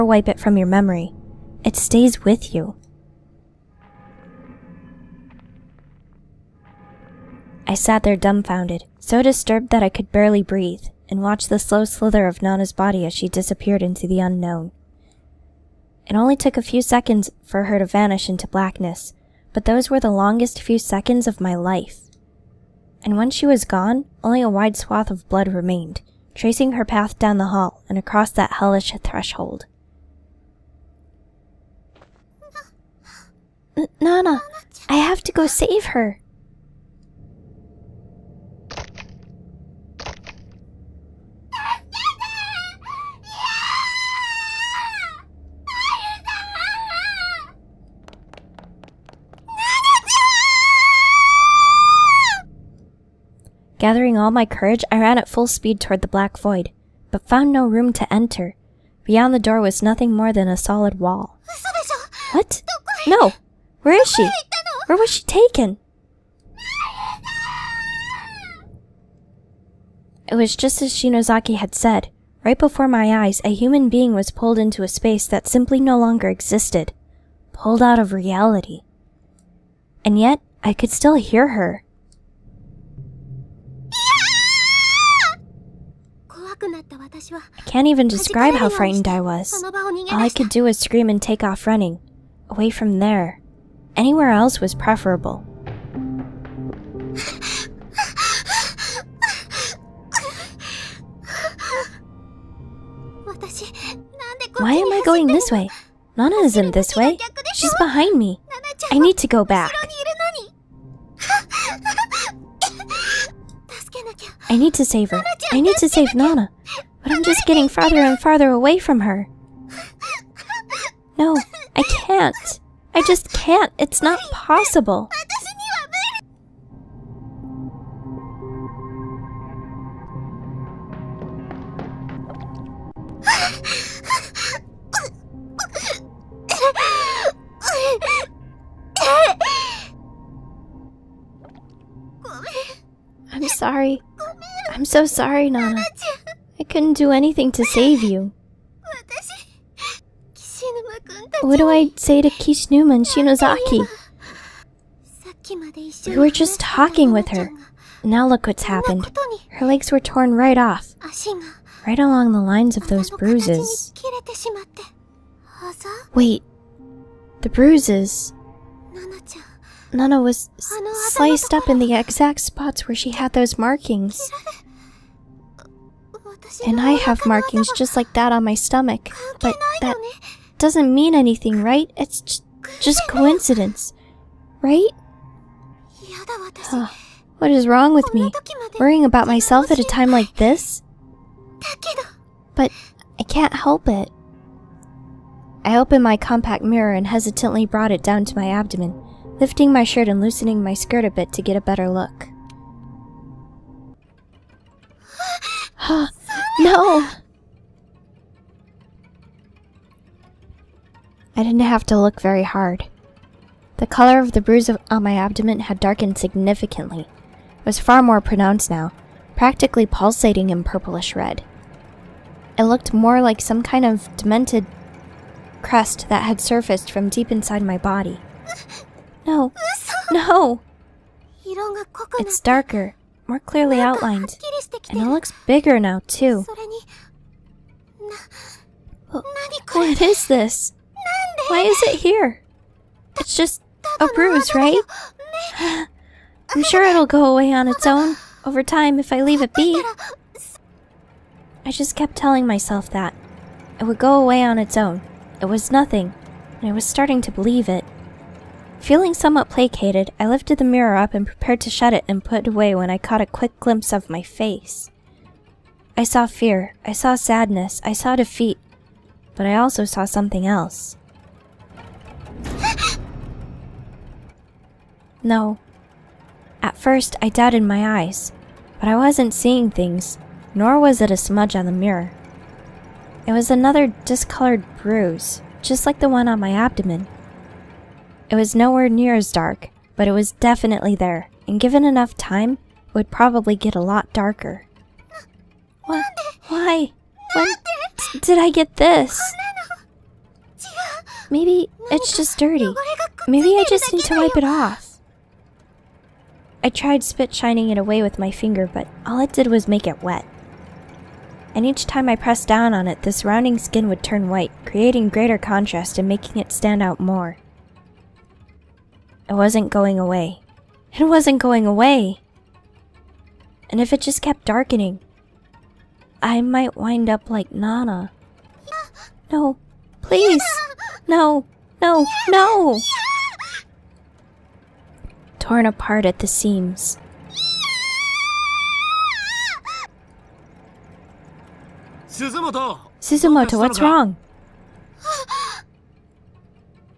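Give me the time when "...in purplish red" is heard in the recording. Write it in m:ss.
3:40.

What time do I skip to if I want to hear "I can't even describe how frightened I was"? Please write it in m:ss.
1:27.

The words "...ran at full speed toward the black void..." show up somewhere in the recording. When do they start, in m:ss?
0:54.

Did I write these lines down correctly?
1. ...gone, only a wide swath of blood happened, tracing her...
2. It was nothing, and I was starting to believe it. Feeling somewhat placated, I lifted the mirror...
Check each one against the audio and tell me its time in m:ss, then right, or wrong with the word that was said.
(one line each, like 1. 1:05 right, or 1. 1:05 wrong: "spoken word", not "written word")
1. 0:23 wrong: "remained", not "happened"
2. 4:15 right.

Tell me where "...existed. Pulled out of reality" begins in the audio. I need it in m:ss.
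1:16.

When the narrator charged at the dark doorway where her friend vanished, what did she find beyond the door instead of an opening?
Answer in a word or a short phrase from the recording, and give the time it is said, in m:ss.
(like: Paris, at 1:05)
A solid wall, at 1:00.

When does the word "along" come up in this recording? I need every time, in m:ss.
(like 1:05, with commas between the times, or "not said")
2:41.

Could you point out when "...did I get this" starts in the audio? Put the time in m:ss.
4:58.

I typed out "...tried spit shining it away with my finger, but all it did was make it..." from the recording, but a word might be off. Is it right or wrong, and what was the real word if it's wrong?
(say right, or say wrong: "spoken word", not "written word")
right.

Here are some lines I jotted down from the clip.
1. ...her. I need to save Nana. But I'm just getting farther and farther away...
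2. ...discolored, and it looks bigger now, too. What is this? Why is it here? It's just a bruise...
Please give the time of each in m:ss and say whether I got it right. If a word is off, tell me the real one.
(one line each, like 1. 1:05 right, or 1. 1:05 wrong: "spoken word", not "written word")
1. 1:55 right
2. 3:53 wrong: "outlined", not "discolored".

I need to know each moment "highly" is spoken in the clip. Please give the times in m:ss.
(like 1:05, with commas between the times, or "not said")
not said.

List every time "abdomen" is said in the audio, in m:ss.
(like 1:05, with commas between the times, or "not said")
3:18, 3:35, 4:46.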